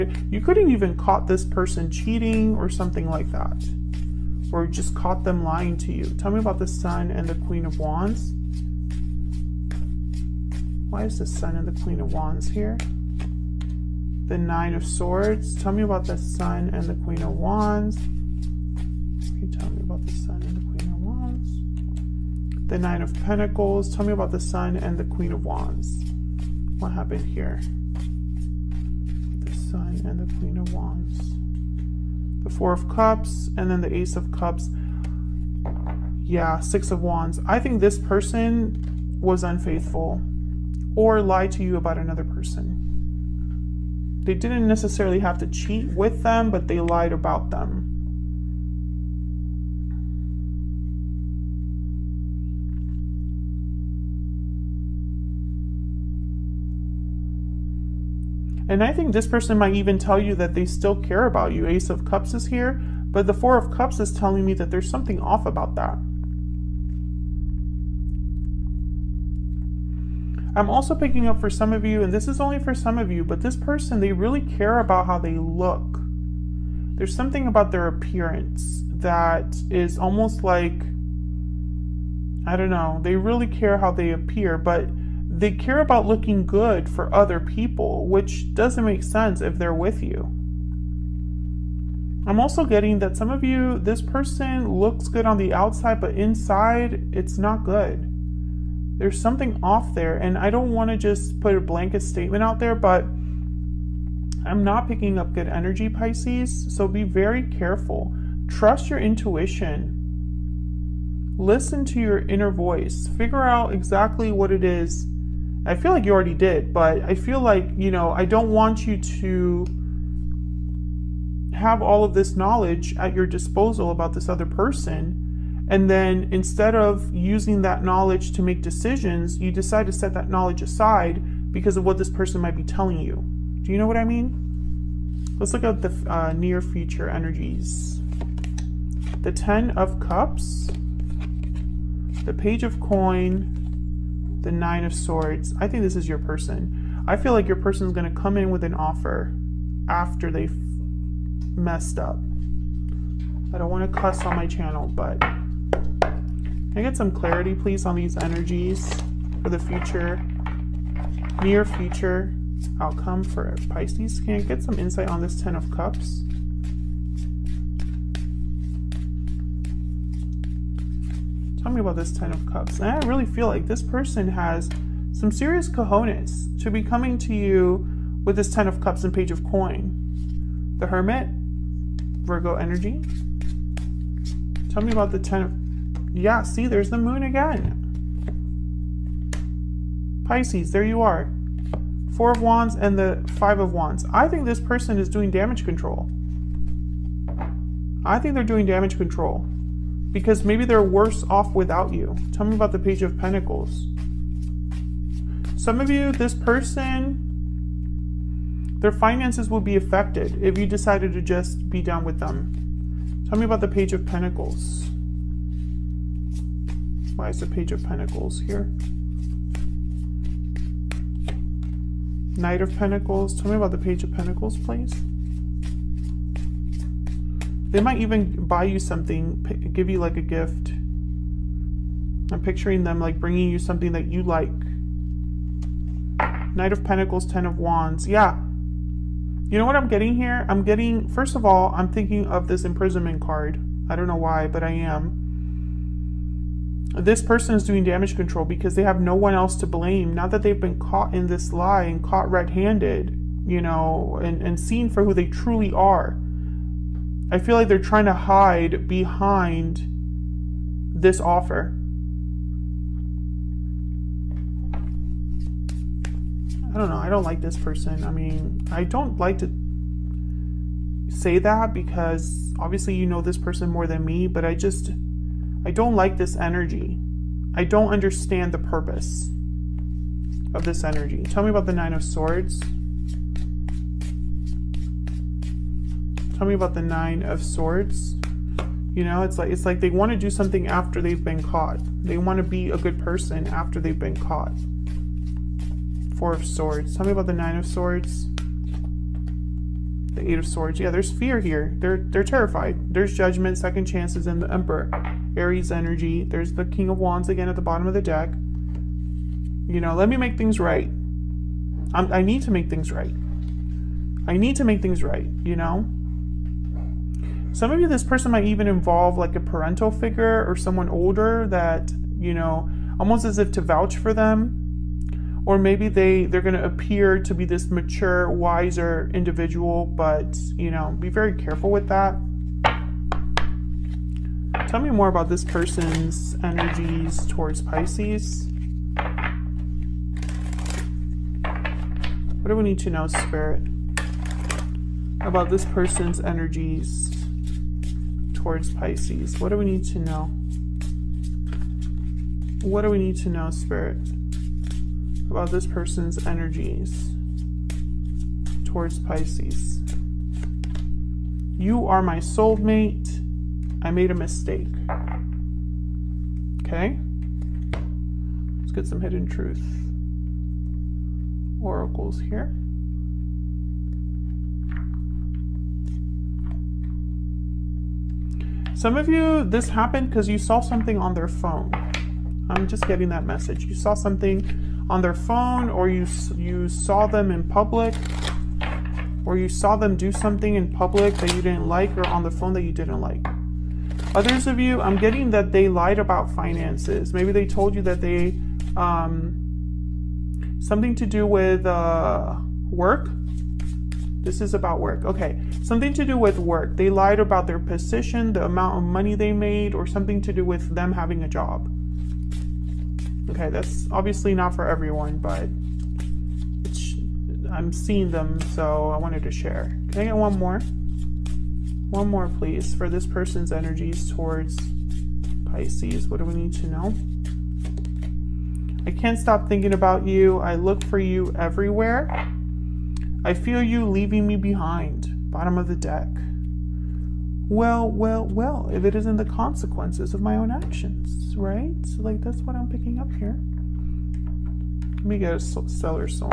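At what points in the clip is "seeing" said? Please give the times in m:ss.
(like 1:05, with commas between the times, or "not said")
6:57.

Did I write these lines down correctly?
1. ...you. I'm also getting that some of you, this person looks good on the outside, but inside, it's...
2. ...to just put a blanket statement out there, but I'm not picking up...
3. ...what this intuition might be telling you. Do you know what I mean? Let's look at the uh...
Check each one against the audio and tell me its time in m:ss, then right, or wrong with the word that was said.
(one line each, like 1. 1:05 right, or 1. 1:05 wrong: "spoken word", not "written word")
1. 1:30 right
2. 1:40 right
3. 2:11 wrong: "person", not "intuition".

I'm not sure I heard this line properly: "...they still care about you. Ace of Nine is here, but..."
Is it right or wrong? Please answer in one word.
wrong.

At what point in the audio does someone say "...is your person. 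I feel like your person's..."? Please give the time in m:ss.
2:25.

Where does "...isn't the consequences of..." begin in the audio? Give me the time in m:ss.
7:18.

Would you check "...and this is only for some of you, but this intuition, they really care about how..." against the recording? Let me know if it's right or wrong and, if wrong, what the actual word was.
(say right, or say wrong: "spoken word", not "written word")
wrong: "person", not "intuition".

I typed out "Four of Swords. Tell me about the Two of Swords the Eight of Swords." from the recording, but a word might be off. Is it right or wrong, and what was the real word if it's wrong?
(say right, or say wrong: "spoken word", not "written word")
wrong: "Nine", not "Two".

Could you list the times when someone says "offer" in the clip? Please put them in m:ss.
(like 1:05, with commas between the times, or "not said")
2:28, 4:21.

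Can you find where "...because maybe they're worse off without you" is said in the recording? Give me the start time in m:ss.
3:20.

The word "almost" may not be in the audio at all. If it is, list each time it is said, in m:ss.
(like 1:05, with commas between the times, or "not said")
1:19, 5:22.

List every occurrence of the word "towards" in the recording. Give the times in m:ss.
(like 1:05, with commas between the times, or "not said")
5:37, 5:48, 5:58, 7:04.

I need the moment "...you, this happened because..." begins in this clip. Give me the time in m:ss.
6:19.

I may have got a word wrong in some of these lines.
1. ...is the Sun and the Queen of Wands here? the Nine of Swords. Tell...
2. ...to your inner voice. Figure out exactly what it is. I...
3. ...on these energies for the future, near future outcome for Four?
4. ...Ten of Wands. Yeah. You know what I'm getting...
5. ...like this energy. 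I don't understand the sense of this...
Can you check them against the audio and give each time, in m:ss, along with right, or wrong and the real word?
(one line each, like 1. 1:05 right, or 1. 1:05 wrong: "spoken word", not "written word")
1. 0:11 right
2. 1:51 right
3. 2:37 wrong: "Pisces", not "Four"
4. 3:57 right
5. 4:35 wrong: "purpose", not "sense".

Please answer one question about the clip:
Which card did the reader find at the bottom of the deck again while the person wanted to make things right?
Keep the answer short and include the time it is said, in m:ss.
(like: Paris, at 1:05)
King of Wands, at 5:06.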